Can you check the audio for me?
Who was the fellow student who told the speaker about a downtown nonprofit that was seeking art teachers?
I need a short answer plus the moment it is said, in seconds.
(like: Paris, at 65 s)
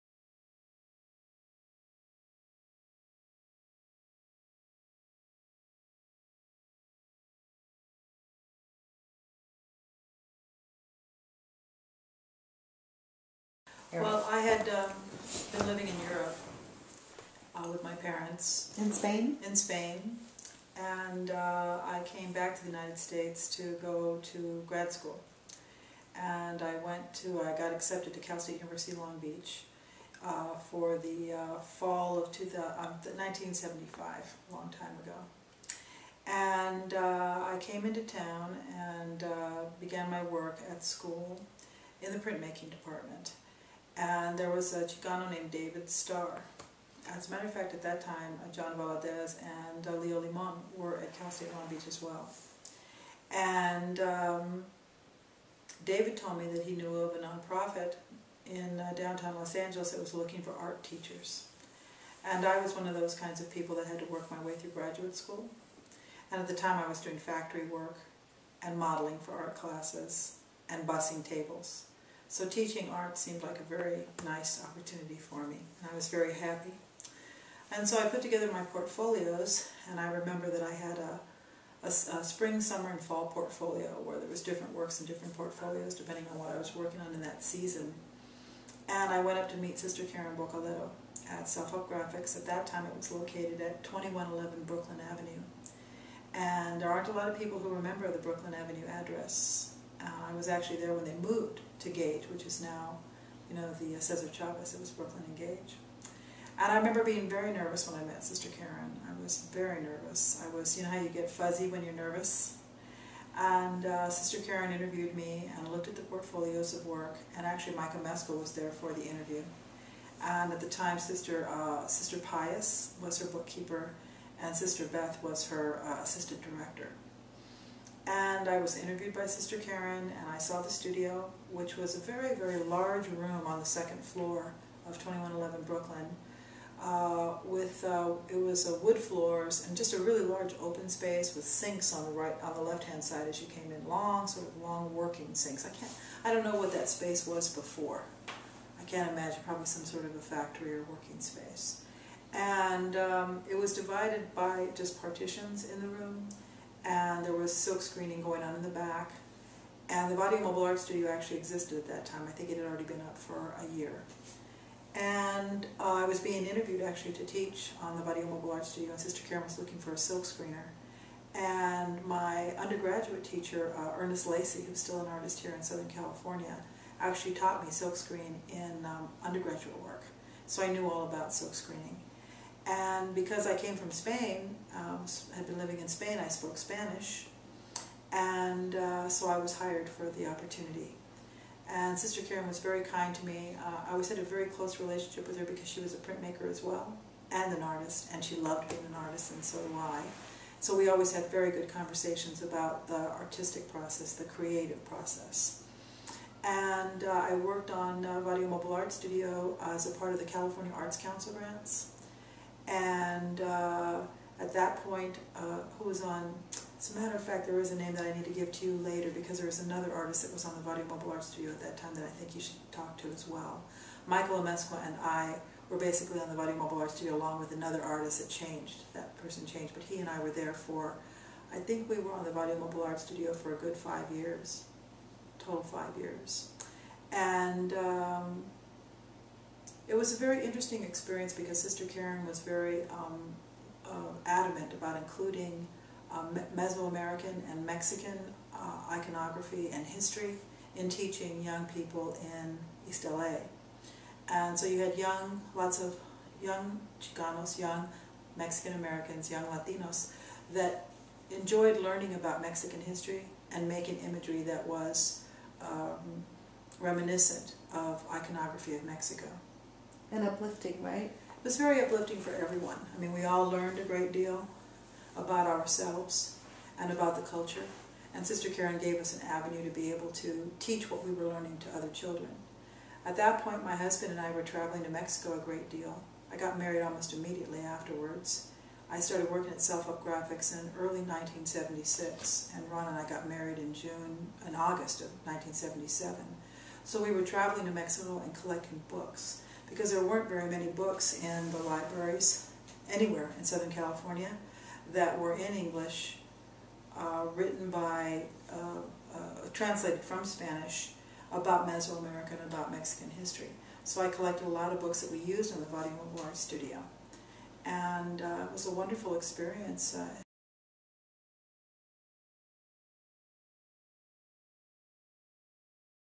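David Starr, at 45 s.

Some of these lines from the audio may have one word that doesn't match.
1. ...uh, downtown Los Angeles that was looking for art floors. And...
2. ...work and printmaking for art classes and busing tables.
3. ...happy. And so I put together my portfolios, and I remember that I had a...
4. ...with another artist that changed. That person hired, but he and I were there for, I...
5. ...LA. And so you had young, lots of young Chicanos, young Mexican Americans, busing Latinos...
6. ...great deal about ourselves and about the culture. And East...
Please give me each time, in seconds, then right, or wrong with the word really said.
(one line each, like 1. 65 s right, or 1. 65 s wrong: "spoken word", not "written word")
1. 58 s wrong: "teachers", not "floors"
2. 67 s wrong: "modeling", not "printmaking"
3. 76 s right
4. 227 s wrong: "changed", not "hired"
5. 253 s wrong: "young", not "busing"
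6. 273 s wrong: "Sister", not "East".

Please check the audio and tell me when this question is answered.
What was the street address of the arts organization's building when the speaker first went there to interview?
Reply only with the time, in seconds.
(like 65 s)
93 s.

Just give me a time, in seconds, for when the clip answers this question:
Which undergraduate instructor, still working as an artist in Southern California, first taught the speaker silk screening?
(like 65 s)
173 s.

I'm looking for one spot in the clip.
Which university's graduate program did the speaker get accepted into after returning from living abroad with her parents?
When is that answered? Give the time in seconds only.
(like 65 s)
28 s.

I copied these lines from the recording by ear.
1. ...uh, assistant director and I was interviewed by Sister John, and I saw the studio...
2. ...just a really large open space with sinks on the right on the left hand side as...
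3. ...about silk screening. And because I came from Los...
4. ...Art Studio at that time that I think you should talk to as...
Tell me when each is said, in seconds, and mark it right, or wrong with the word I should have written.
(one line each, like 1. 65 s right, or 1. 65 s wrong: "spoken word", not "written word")
1. 125 s wrong: "Karen", not "John"
2. 139 s right
3. 181 s wrong: "Spain", not "Los"
4. 221 s right.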